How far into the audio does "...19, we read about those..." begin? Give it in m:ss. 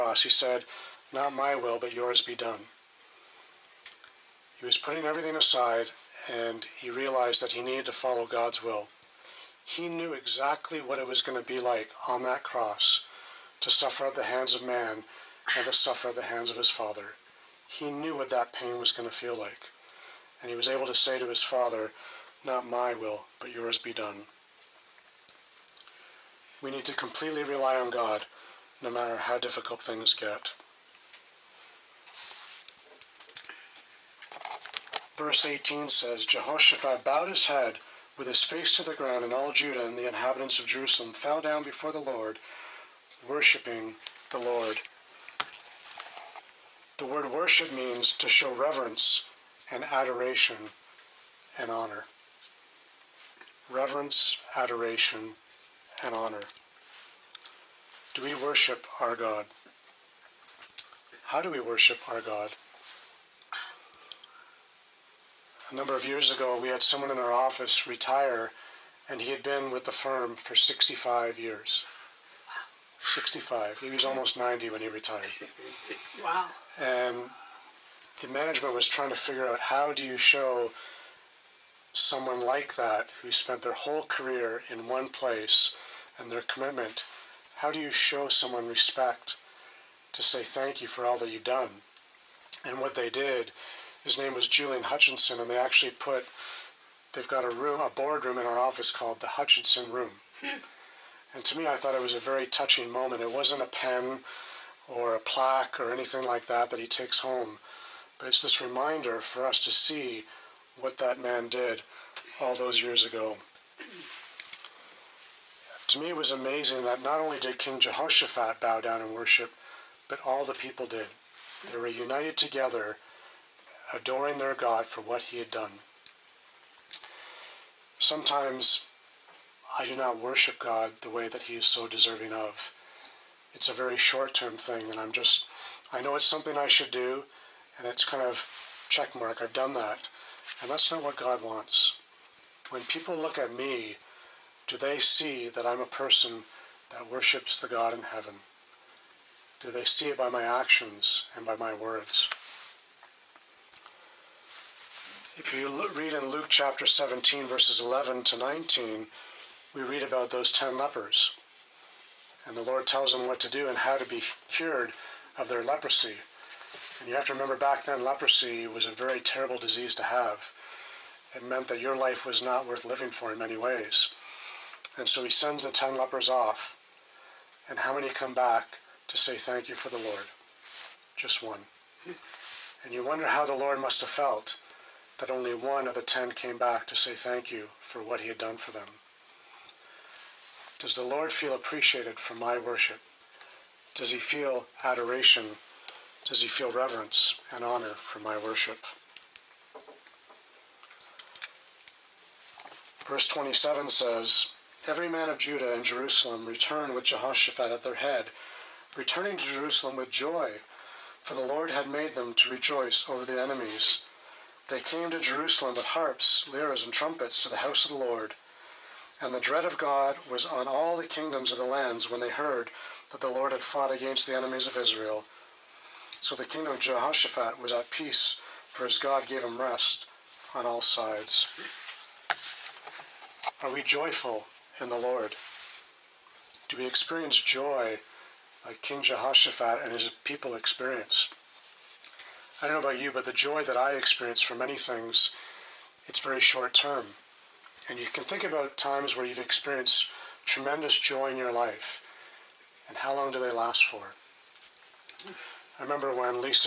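2:38.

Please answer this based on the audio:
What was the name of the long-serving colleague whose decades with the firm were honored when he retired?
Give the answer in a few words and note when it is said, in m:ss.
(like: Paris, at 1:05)
Julian Hutchinson, at 1:34.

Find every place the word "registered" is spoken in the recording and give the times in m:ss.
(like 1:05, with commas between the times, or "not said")
not said.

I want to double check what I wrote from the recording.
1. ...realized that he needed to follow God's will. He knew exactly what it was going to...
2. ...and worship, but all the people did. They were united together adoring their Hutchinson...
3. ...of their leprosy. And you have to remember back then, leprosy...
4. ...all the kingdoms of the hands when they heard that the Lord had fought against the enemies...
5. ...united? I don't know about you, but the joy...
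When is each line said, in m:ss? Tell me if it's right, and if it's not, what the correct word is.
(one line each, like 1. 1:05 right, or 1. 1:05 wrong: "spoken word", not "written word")
1. 0:06 right
2. 1:59 wrong: "God", not "Hutchinson"
3. 2:45 right
4. 3:40 wrong: "lands", not "hands"
5. 4:00 wrong: "experienced", not "united".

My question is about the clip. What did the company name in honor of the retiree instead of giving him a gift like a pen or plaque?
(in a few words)
Hutchinson Room.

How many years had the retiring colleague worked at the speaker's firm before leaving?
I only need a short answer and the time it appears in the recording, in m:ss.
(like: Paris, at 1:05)
65, at 1:10.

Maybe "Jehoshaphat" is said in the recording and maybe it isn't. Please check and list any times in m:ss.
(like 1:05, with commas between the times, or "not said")
0:36, 1:57, 3:27, 3:46, 3:59.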